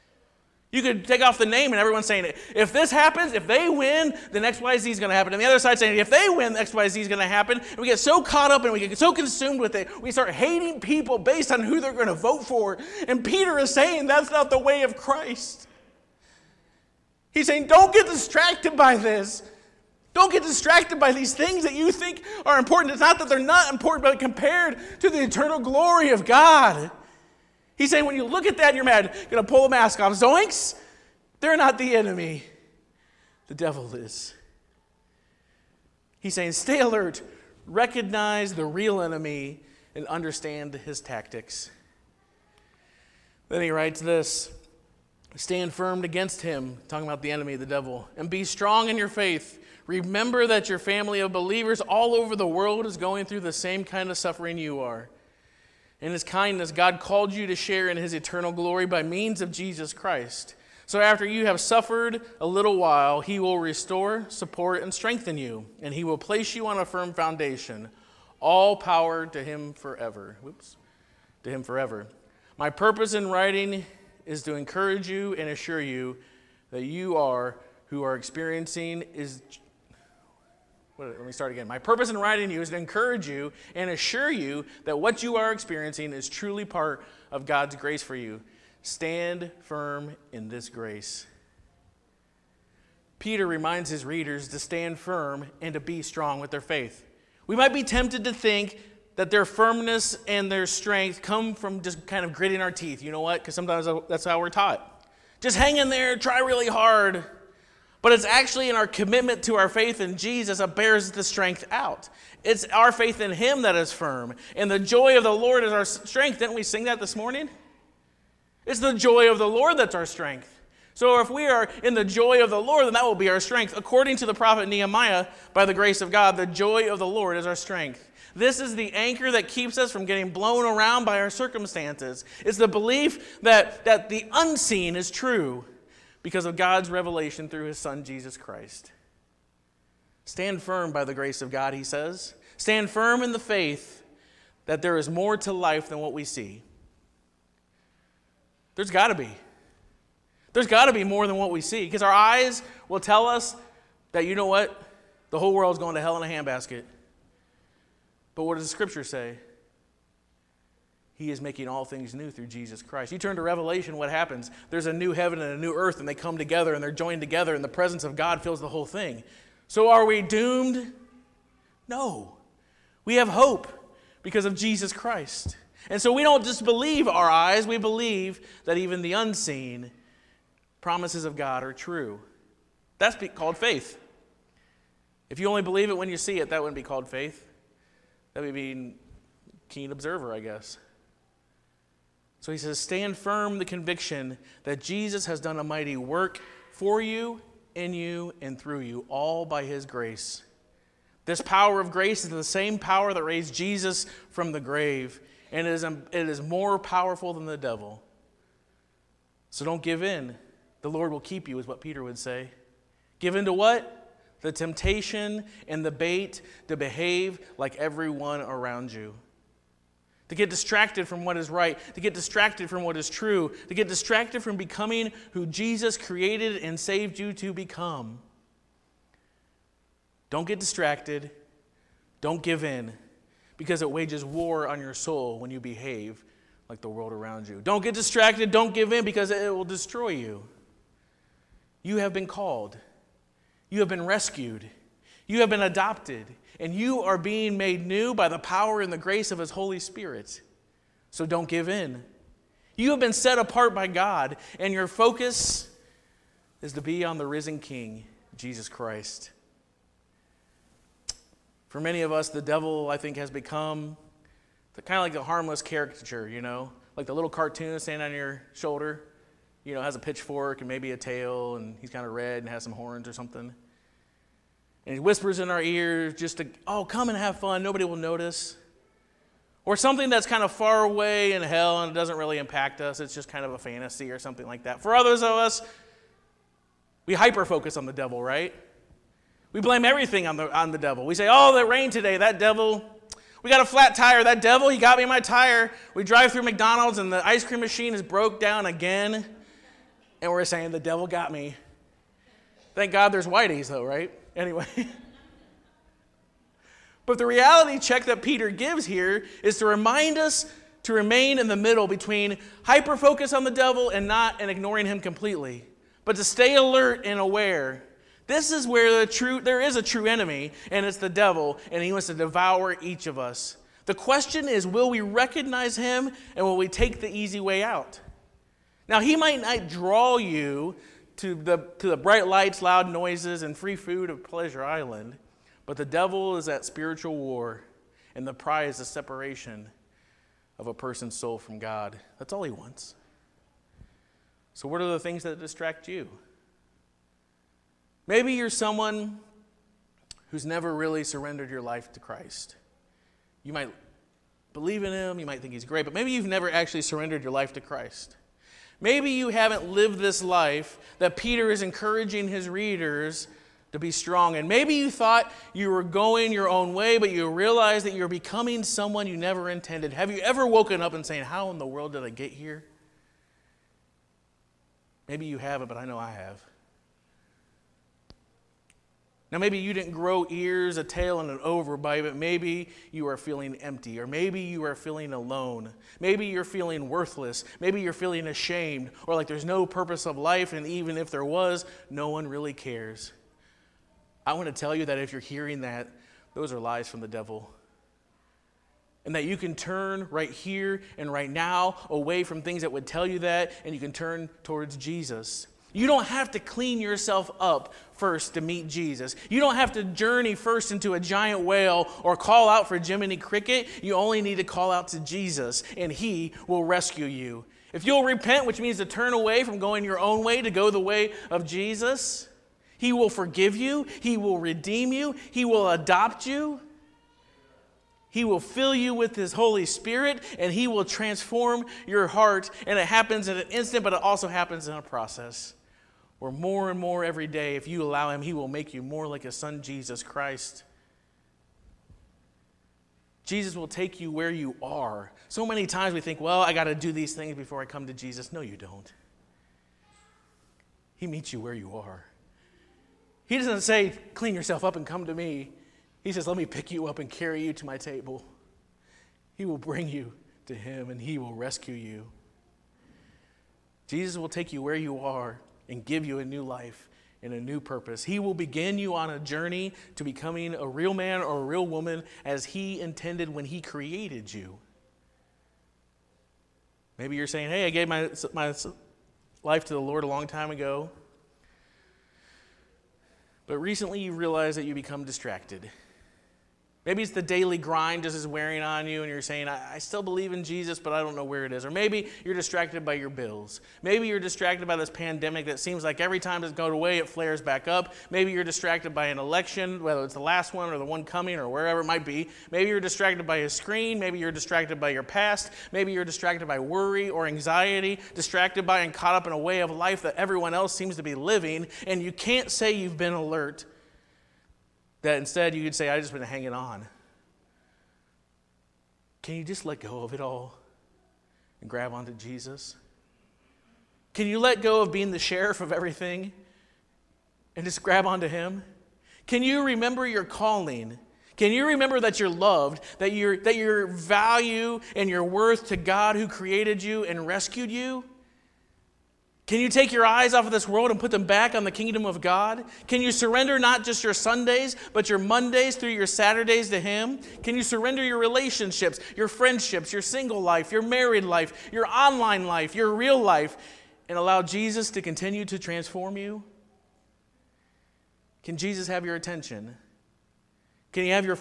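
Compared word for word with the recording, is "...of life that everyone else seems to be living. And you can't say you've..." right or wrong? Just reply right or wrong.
right.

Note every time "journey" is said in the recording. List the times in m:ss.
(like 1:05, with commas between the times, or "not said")
6:49, 7:49.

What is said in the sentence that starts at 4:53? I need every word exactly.
We got a flat tire, that devil, he got me my tire.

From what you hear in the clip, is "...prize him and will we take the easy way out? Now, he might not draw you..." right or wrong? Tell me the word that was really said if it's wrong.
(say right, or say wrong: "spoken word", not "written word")
wrong: "recognize", not "prize".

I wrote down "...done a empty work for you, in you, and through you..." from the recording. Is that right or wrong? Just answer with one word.
wrong.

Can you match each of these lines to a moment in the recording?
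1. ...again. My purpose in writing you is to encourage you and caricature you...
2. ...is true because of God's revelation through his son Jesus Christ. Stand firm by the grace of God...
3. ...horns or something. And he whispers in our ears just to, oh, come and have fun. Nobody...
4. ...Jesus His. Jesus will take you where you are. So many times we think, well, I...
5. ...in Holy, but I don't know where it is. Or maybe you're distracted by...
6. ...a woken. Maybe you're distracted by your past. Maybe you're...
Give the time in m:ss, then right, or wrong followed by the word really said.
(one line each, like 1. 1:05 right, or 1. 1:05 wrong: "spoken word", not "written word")
1. 1:21 wrong: "assure", not "caricature"
2. 2:14 right
3. 4:32 right
4. 7:19 wrong: "Christ", not "His"
5. 8:10 wrong: "Jesus", not "Holy"
6. 8:23 wrong: "screen", not "woken".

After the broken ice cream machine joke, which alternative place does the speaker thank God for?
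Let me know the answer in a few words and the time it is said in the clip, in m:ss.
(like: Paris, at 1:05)
Whitey's, at 5:03.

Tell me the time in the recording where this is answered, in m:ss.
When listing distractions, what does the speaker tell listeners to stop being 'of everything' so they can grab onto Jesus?
8:45.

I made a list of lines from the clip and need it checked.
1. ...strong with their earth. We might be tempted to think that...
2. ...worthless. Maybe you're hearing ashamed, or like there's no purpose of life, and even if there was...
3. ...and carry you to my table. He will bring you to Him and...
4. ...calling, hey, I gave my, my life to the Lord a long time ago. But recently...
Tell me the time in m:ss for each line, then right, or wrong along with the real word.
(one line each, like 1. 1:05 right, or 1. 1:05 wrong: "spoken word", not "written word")
1. 1:36 wrong: "faith", not "earth"
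2. 6:26 wrong: "feeling", not "hearing"
3. 7:37 right
4. 7:57 wrong: "saying", not "calling".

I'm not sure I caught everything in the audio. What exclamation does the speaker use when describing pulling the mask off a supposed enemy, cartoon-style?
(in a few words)
Zoinks.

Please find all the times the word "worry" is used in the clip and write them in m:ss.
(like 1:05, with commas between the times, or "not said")
8:26.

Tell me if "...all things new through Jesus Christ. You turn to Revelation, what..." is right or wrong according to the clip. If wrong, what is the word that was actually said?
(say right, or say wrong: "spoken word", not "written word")
right.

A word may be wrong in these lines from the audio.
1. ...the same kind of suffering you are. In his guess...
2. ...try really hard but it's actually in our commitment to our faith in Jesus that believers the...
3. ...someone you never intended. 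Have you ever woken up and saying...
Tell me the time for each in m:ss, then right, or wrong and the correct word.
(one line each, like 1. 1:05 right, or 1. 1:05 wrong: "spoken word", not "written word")
1. 0:53 wrong: "kindness", not "guess"
2. 1:46 wrong: "bears", not "believers"
3. 6:08 right.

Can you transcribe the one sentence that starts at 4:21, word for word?
For many of us, the devil, I think, has become kind of like the harmless caricature, you know?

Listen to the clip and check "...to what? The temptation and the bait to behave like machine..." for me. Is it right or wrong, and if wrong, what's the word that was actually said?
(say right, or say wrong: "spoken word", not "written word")
wrong: "everyone", not "machine".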